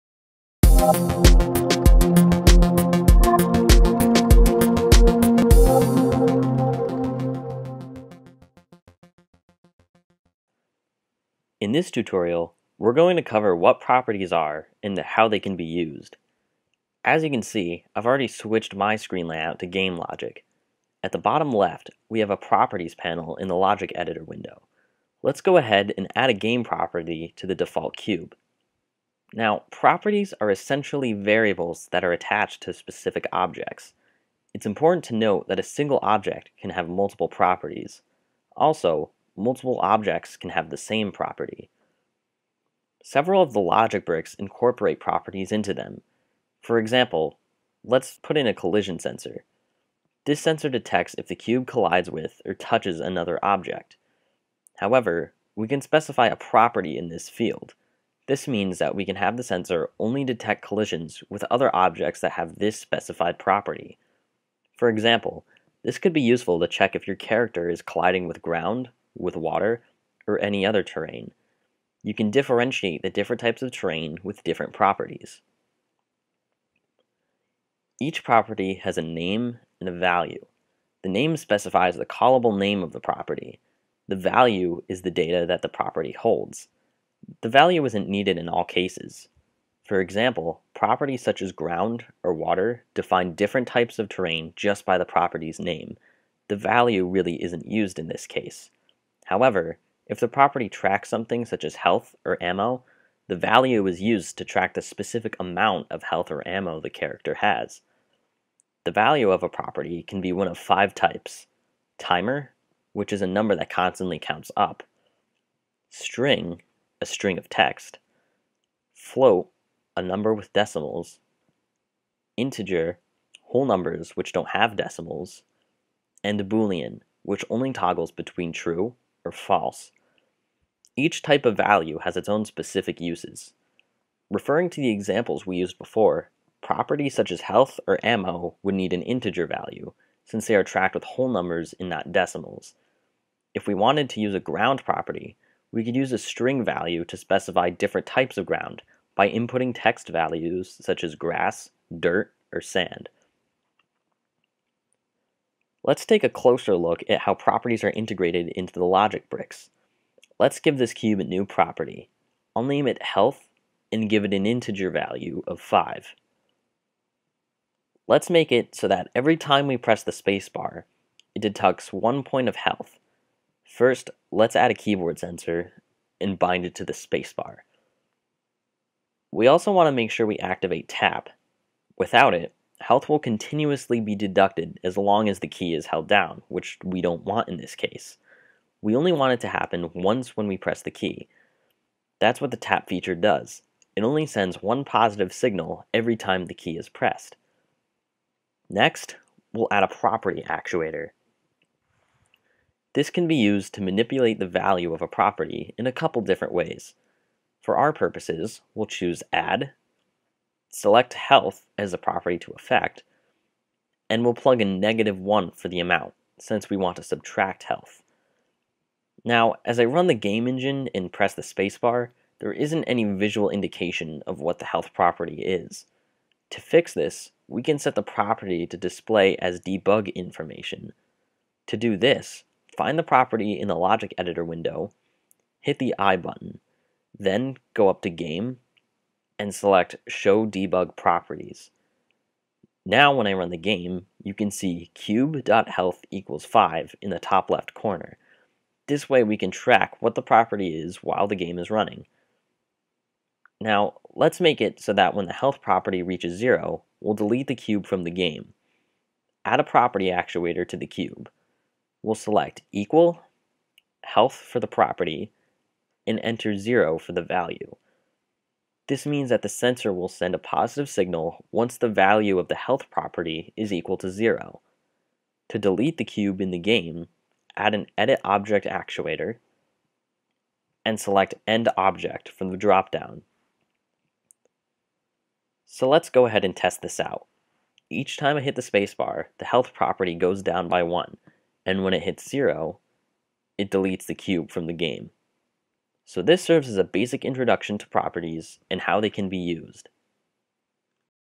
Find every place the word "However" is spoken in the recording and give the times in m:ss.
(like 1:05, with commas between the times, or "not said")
0:54, 1:39.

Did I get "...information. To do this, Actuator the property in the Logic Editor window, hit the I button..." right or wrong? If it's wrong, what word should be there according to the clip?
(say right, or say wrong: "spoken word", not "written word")
wrong: "Find", not "Actuator".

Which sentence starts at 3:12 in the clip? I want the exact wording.
That's what the tap feature does.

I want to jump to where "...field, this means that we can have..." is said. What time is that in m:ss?
0:57.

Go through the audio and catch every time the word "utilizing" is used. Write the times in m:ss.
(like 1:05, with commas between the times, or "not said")
not said.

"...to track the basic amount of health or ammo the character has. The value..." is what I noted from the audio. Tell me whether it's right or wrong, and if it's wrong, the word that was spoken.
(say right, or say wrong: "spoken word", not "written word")
wrong: "specific", not "basic".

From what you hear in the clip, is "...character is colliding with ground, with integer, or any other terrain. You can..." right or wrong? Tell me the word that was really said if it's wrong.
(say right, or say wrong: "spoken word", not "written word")
wrong: "water", not "integer".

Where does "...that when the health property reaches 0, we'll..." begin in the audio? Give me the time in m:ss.
4:14.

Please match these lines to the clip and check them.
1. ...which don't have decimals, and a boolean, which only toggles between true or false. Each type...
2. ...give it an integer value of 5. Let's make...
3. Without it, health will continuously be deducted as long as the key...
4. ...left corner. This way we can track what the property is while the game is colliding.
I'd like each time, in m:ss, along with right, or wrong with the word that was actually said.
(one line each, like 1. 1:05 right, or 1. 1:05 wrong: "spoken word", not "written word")
1. 2:04 right
2. 2:44 right
3. 3:01 right
4. 4:07 wrong: "running", not "colliding".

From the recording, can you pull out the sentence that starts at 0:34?
It's important to note that a single object can have multiple properties.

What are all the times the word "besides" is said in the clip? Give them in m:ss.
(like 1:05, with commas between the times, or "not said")
not said.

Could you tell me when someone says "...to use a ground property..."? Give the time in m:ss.
2:24.